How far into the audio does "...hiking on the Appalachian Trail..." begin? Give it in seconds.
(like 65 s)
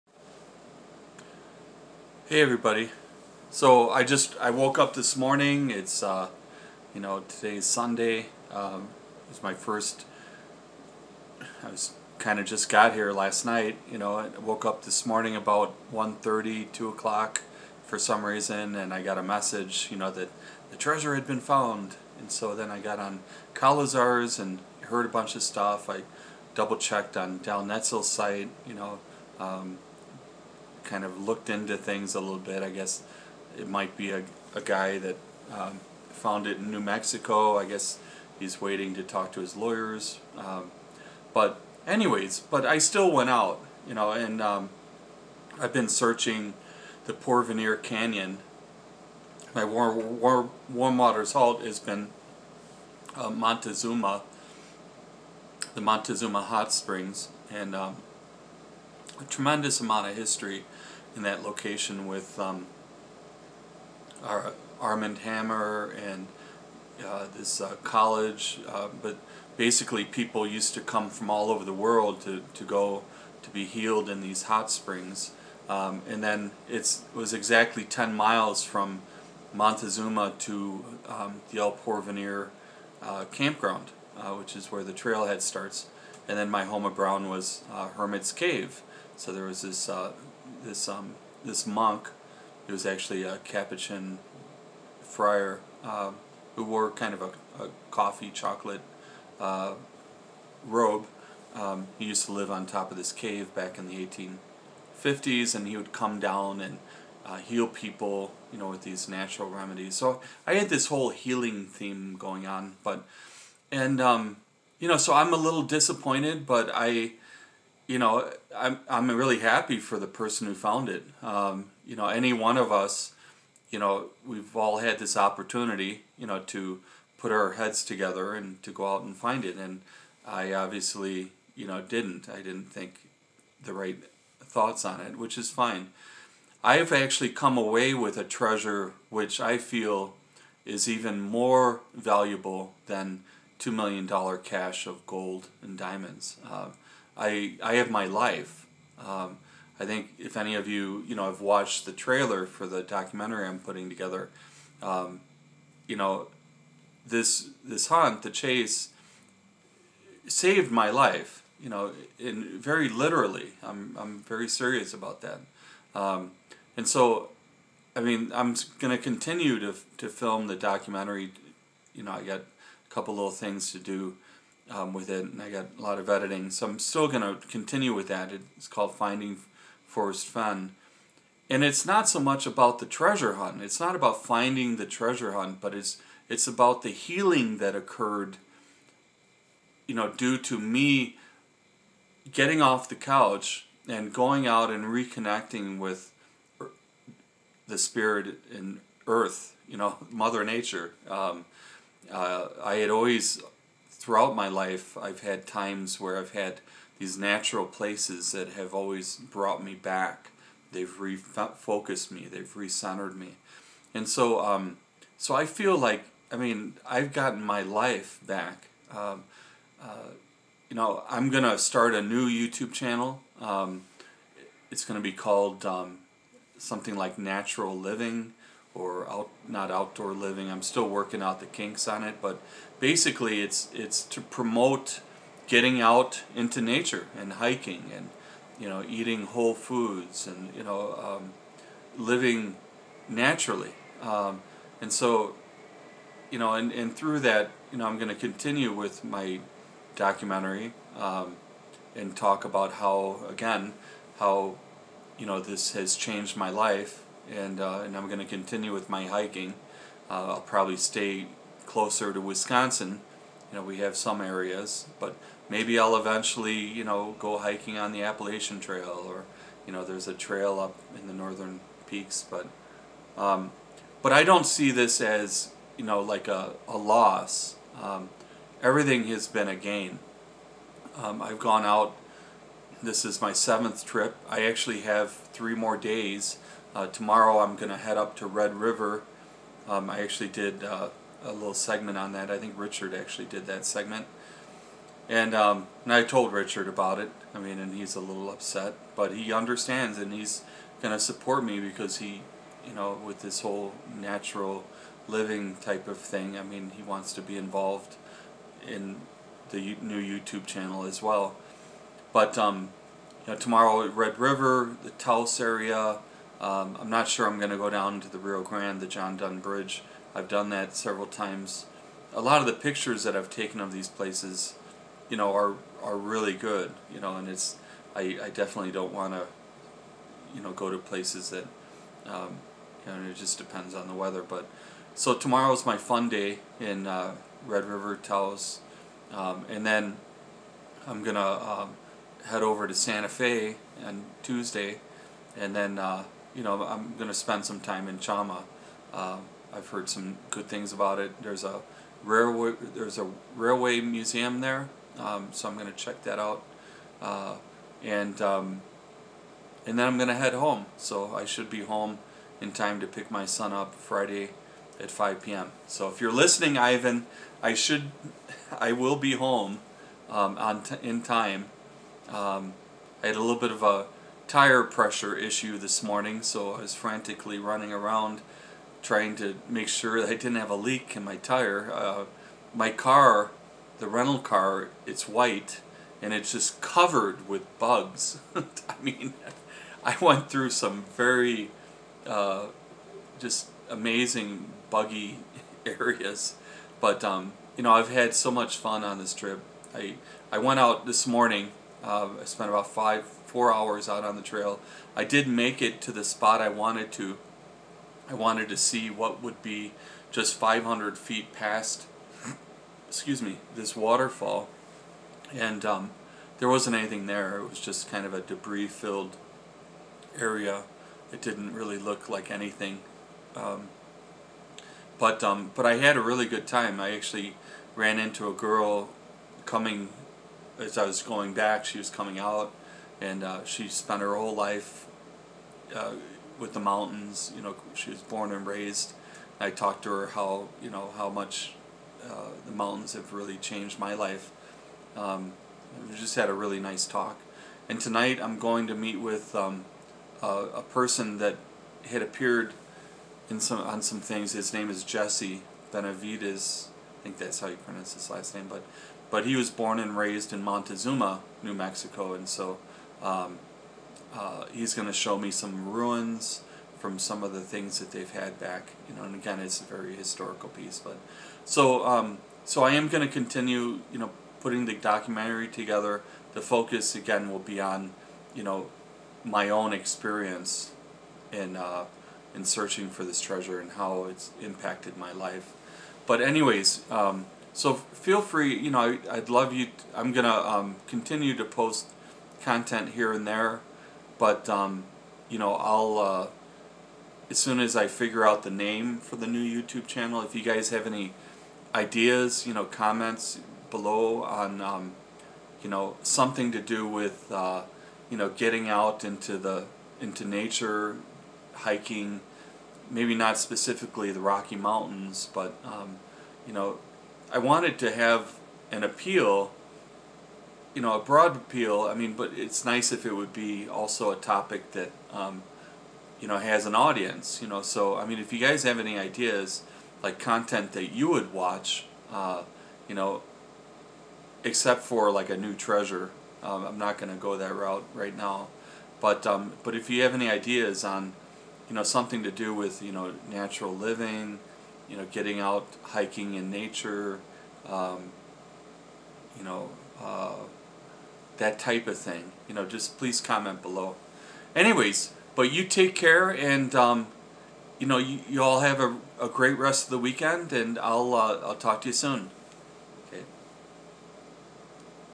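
267 s.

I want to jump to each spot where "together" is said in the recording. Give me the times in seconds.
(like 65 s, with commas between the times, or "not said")
127 s, 153 s, 475 s.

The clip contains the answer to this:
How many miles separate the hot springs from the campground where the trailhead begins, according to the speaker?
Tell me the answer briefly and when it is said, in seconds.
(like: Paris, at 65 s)
10, at 77 s.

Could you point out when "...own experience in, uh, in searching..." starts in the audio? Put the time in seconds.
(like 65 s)
479 s.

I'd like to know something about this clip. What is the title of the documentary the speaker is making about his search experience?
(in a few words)
Finding Forrest Fenn.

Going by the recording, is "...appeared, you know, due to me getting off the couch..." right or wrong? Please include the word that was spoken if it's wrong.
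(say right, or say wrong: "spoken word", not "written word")
wrong: "occurred", not "appeared".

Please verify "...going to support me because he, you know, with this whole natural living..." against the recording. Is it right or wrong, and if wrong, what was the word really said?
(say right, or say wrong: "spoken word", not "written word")
right.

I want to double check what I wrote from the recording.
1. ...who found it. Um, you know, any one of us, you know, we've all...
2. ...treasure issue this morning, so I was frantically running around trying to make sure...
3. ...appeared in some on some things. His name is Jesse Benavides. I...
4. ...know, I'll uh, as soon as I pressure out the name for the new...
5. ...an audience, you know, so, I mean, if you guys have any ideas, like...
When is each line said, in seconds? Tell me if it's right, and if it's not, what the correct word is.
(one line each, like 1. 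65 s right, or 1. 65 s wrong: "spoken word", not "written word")
1. 120 s right
2. 374 s wrong: "pressure", not "treasure"
3. 452 s right
4. 495 s wrong: "figure", not "pressure"
5. 526 s right.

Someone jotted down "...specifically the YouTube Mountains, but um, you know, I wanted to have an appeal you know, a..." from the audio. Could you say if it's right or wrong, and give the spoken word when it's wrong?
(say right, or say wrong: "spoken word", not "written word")
wrong: "Rocky", not "YouTube".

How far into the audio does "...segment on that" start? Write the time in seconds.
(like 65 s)
291 s.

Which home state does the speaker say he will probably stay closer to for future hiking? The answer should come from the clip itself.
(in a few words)
Wisconsin.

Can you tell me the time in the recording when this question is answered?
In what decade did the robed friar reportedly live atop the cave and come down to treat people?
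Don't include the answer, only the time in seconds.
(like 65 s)
105 s.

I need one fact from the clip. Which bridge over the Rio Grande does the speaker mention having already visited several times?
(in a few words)
John Dunn Bridge.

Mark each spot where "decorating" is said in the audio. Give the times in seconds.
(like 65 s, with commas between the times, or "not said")
not said.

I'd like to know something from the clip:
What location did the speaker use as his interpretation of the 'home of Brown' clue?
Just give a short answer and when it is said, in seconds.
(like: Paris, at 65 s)
Hermit's Cave, at 87 s.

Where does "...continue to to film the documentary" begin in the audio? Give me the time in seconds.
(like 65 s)
168 s.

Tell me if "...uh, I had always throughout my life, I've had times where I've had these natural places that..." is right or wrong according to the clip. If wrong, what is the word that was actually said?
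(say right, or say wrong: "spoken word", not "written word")
right.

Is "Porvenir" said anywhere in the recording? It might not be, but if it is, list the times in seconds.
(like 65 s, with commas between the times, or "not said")
47 s, 81 s.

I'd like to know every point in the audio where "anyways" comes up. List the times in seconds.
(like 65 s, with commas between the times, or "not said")
41 s, 486 s, 554 s.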